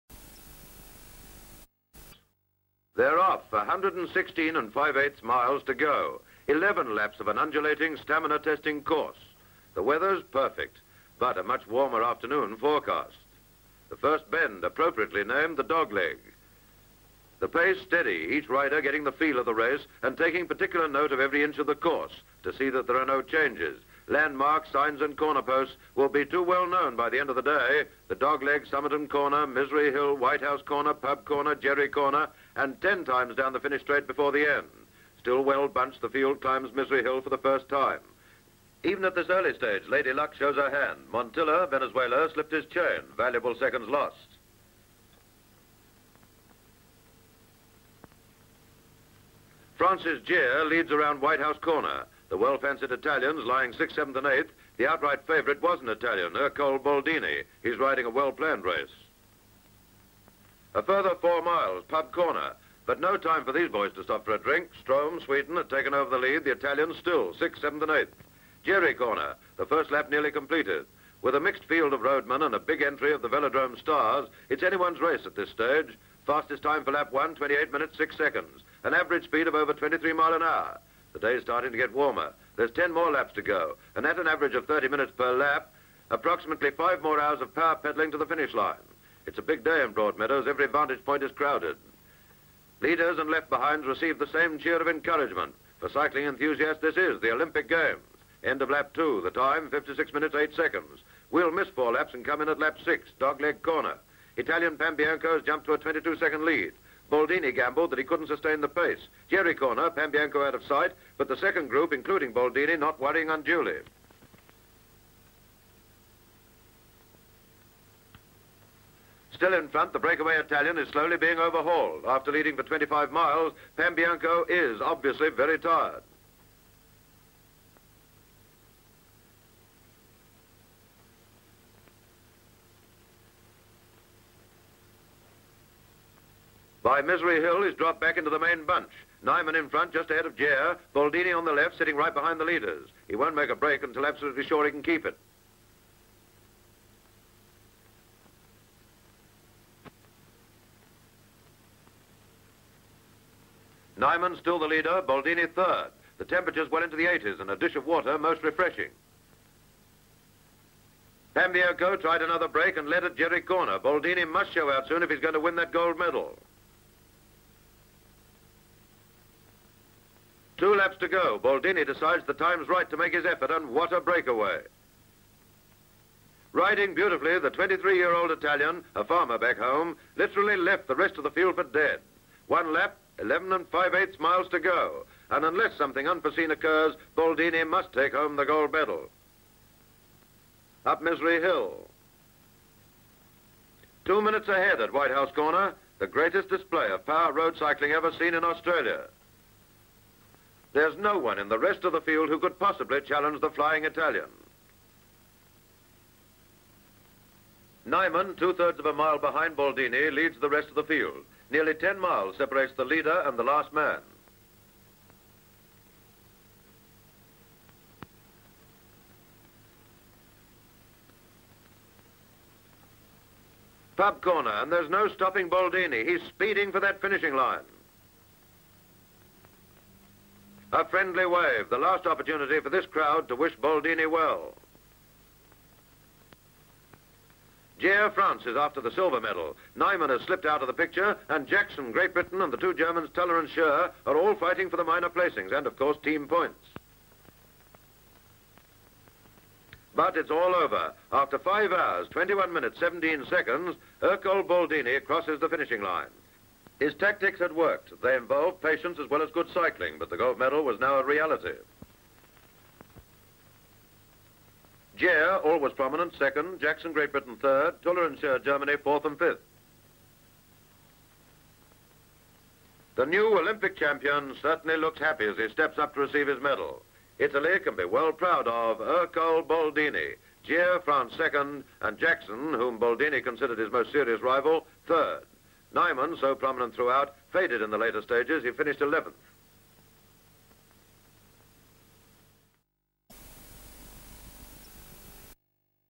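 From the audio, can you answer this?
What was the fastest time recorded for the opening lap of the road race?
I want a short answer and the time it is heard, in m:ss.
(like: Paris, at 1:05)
28 minutes, 6 seconds, at 1:17.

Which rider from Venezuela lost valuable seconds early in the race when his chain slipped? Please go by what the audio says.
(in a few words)
Montilla.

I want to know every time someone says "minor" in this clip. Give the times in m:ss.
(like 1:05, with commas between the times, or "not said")
4:04.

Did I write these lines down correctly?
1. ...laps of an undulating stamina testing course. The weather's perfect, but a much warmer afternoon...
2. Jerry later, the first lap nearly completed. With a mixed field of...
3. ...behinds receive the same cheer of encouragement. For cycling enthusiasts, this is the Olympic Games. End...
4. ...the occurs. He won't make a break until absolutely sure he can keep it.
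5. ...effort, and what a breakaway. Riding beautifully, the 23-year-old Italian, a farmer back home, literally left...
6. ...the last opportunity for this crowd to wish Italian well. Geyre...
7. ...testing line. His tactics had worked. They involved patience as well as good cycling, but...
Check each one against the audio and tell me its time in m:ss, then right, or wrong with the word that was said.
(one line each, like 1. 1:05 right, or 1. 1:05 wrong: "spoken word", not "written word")
1. 0:06 right
2. 1:08 wrong: "corner", not "later"
3. 1:33 right
4. 2:22 wrong: "leaders", not "occurs"
5. 2:53 right
6. 3:51 wrong: "Baldini", not "Italian"
7. 4:15 wrong: "finishing", not "testing".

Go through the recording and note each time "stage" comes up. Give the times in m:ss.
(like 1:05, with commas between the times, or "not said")
0:39, 1:15, 4:48.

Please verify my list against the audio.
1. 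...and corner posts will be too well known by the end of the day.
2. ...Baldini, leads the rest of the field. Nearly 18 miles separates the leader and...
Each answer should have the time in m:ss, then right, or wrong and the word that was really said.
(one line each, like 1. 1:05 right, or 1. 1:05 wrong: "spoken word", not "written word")
1. 0:25 right
2. 3:29 wrong: "10", not "18".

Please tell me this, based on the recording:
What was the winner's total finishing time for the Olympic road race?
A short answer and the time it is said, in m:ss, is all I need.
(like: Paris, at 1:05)
5 hours, 21 minutes, 17 seconds, at 4:11.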